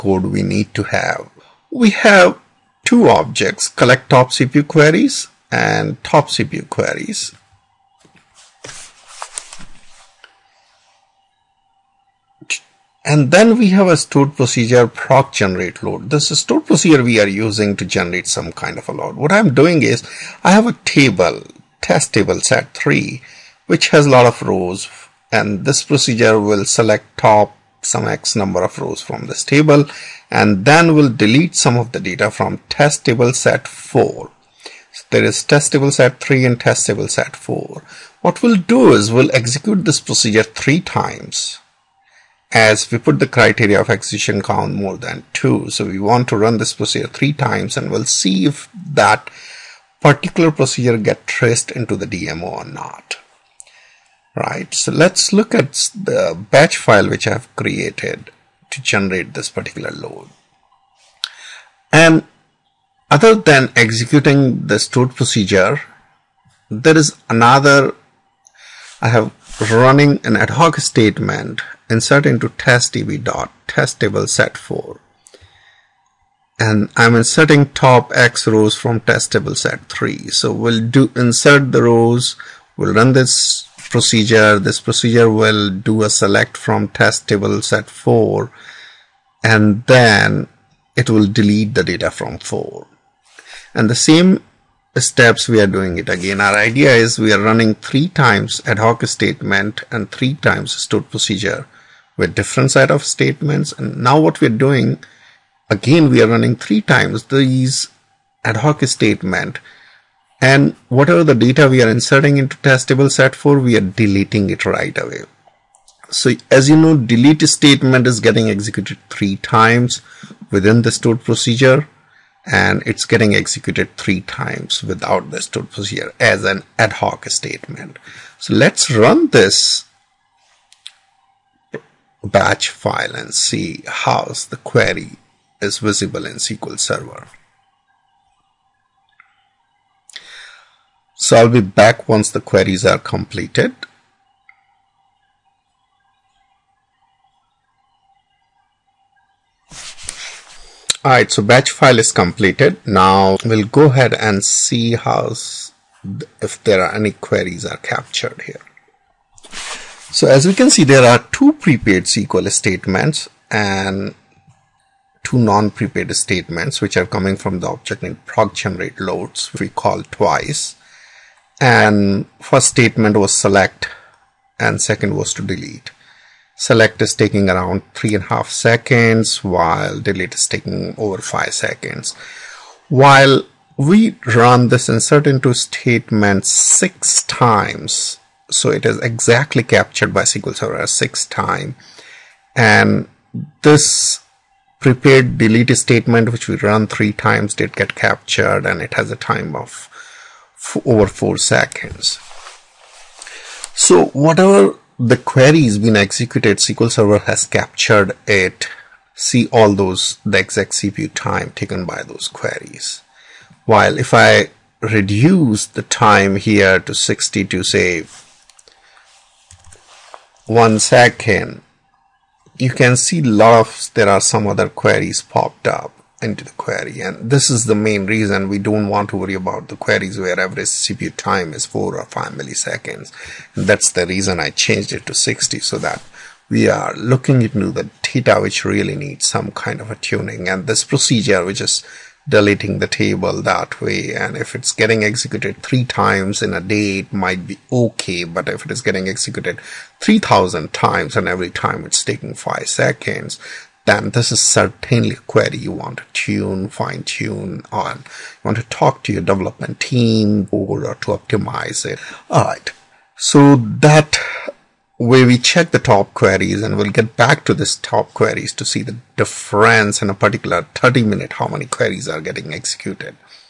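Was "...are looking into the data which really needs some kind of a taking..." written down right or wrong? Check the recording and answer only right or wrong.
wrong.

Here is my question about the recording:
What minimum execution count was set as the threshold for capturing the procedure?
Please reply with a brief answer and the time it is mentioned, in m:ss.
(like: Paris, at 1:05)
more than 2, at 0:44.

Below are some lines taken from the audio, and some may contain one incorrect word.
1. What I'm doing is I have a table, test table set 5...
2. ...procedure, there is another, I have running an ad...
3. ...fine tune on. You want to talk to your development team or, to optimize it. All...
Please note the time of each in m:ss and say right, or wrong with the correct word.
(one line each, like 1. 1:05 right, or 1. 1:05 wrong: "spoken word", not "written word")
1. 0:19 wrong: "3", not "5"
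2. 1:05 right
3. 4:16 right.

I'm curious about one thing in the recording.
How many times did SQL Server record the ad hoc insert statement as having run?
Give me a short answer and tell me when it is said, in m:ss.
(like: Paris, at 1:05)
6, at 3:10.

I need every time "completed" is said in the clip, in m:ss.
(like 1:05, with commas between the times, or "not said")
2:22, 2:32.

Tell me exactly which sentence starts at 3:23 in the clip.
So whatever the query has been executed, SQL Server has captured it.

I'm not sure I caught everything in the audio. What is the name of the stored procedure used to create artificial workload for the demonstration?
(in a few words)
proc generate load.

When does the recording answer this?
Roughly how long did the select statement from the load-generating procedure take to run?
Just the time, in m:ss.
2:57.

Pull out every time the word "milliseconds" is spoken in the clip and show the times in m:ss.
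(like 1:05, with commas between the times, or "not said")
3:52.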